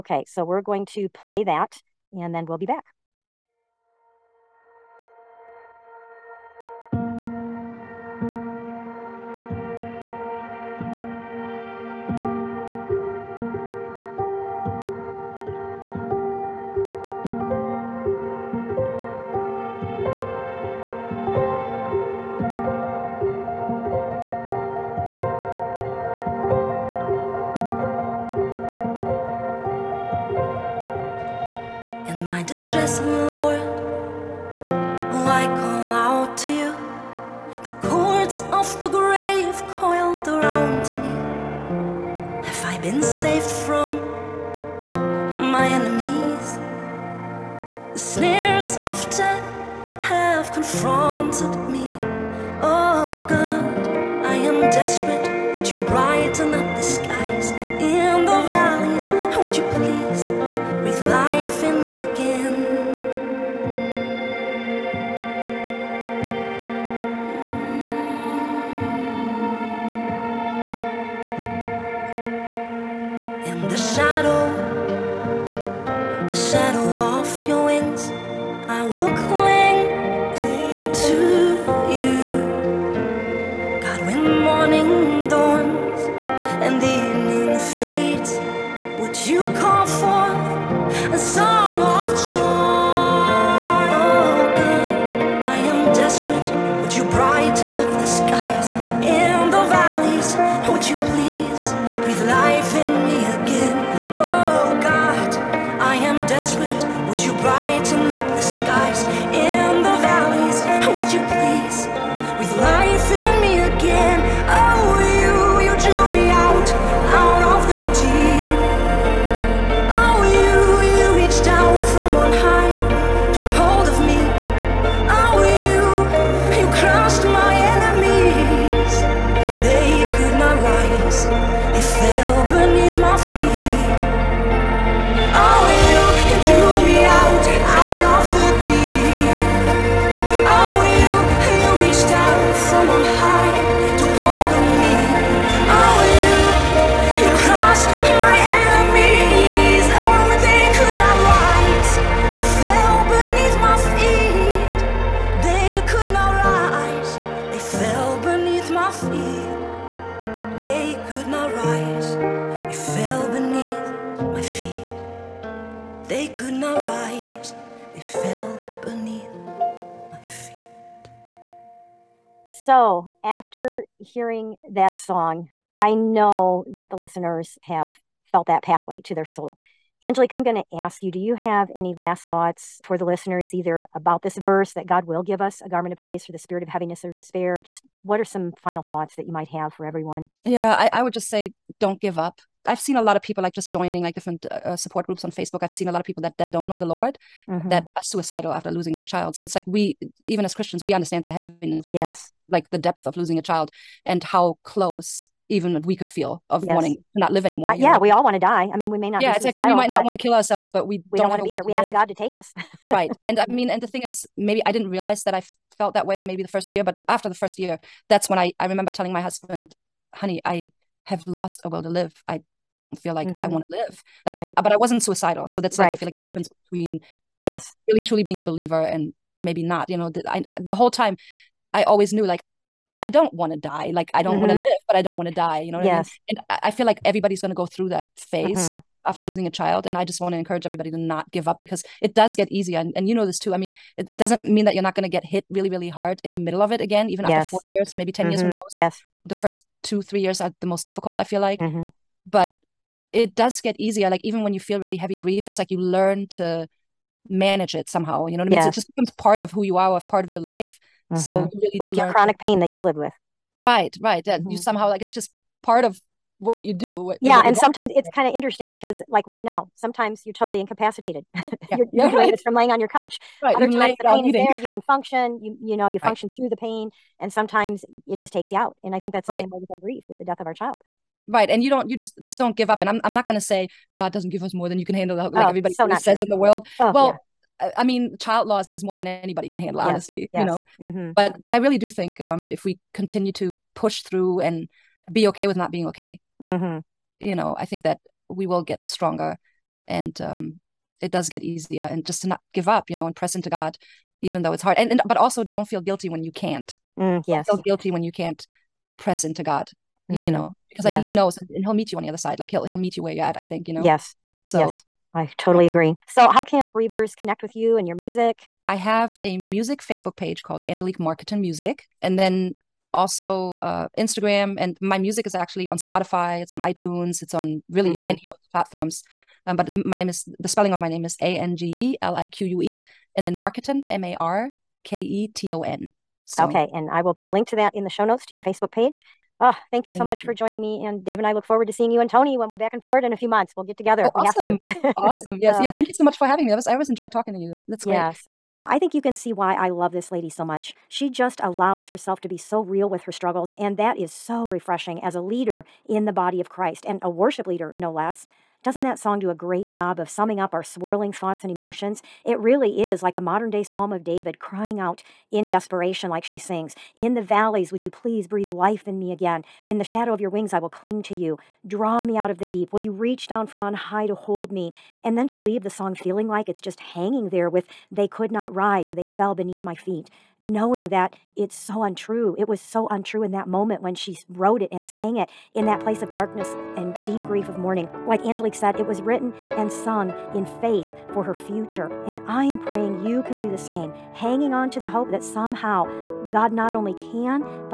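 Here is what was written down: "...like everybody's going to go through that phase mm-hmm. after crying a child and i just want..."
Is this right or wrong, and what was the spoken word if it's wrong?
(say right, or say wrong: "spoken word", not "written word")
wrong: "losing", not "crying".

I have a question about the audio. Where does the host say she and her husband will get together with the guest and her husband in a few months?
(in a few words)
Florida.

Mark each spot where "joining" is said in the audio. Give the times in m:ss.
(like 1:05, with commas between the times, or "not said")
3:13, 5:40.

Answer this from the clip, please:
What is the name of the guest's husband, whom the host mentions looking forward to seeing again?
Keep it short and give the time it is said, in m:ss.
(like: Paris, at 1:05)
Tony, at 5:42.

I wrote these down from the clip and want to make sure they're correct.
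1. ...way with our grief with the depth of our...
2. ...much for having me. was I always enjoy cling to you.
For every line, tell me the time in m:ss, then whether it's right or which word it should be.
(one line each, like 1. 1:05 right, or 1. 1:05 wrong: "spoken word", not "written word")
1. 4:39 wrong: "death", not "depth"
2. 5:46 wrong: "talking", not "cling".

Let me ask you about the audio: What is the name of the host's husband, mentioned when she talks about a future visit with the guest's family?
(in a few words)
Dave.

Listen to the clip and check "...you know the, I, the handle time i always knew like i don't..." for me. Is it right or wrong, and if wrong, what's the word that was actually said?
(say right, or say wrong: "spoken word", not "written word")
wrong: "whole", not "handle".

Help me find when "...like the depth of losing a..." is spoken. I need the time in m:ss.
3:22.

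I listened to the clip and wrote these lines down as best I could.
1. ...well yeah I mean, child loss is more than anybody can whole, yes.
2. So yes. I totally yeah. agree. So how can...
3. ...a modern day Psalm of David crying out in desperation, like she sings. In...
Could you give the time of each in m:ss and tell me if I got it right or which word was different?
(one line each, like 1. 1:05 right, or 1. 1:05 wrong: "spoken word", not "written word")
1. 4:46 wrong: "handle", not "whole"
2. 5:14 right
3. 6:03 right.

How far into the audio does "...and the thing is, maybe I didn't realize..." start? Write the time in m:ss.
3:33.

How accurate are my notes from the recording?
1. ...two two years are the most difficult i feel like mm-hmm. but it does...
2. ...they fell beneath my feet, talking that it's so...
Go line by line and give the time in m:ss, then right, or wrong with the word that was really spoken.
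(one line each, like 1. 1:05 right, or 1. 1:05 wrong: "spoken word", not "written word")
1. 4:09 wrong: "three", not "two"
2. 6:18 wrong: "knowing", not "talking".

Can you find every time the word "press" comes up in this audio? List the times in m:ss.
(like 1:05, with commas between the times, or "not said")
5:03, 5:08.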